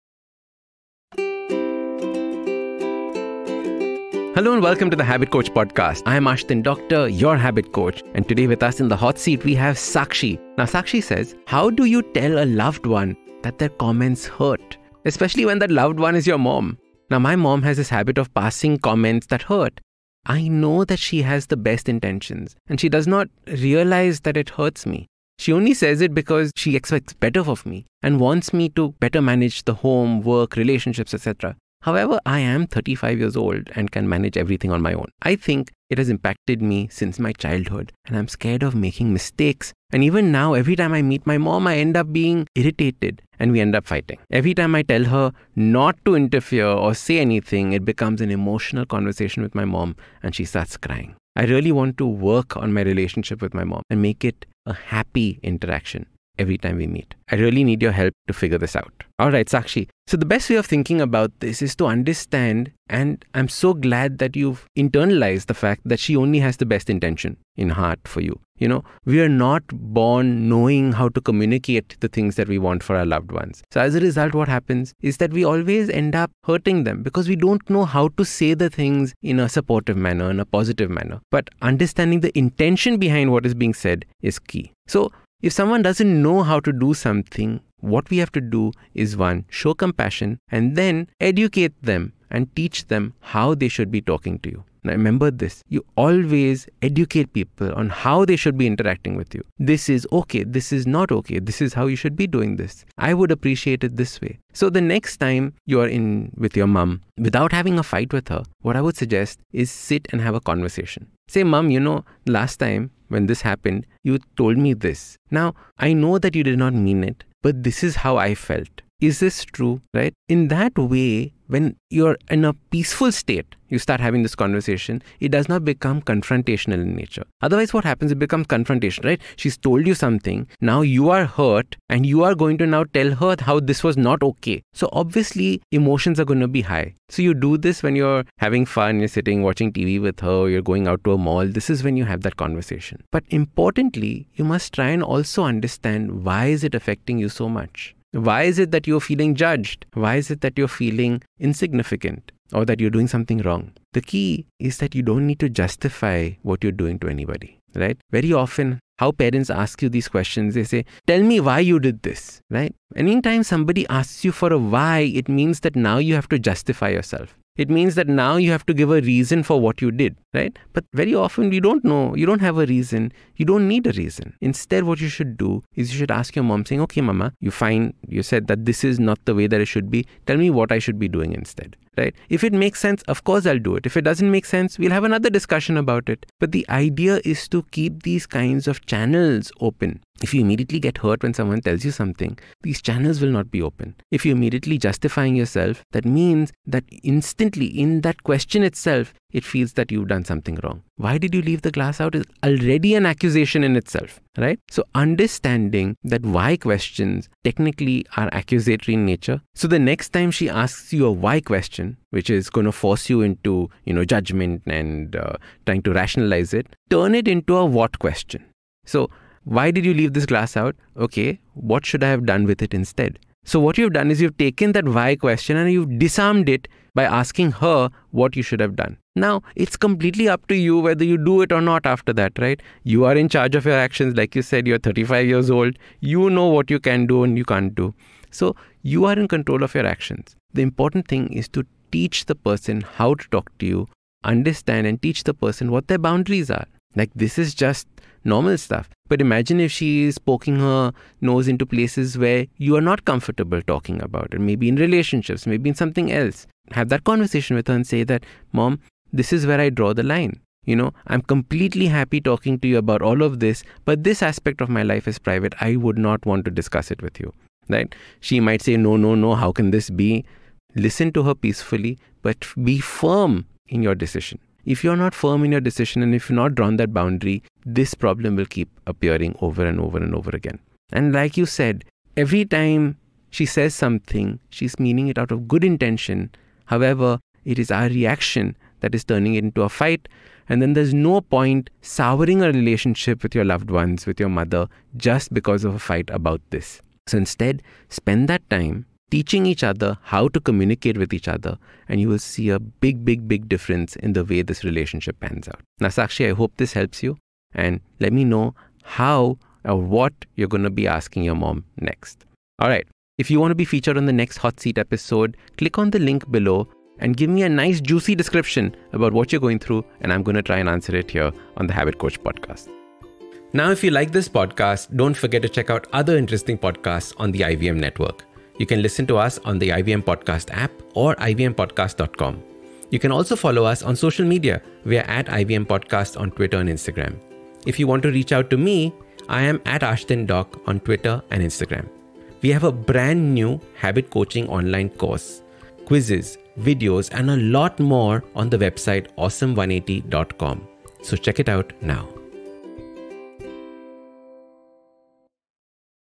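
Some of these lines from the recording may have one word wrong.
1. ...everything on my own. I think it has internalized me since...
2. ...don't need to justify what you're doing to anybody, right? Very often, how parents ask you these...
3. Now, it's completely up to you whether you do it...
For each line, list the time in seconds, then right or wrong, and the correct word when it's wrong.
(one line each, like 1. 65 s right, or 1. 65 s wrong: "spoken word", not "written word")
1. 34 s wrong: "impacted", not "internalized"
2. 155 s right
3. 229 s right.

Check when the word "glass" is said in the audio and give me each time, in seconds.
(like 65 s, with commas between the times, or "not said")
201 s, 220 s.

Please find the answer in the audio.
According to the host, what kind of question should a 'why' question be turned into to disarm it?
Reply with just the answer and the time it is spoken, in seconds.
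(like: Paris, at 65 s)
a what question, at 217 s.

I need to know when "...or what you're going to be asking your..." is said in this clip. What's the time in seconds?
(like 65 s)
309 s.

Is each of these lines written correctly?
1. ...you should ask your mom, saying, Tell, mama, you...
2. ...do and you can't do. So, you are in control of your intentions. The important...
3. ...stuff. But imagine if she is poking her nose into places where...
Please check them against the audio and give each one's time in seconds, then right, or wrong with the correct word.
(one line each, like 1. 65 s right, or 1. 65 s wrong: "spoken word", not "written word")
1. 175 s wrong: "Okay", not "Tell"
2. 237 s wrong: "actions", not "intentions"
3. 248 s right.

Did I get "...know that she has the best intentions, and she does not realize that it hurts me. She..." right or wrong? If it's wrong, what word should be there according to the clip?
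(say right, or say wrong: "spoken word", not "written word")
right.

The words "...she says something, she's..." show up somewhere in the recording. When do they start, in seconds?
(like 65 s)
283 s.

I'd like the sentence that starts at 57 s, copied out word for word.
I really need your help to figure this out.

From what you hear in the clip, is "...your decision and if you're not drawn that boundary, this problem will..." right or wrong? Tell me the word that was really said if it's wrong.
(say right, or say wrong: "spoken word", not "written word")
right.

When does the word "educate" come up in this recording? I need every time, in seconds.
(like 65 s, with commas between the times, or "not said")
91 s, 96 s.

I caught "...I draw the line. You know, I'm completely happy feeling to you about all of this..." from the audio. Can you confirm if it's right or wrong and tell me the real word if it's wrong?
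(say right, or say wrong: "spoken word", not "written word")
wrong: "talking", not "feeling".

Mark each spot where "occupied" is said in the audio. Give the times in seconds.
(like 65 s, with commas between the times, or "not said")
not said.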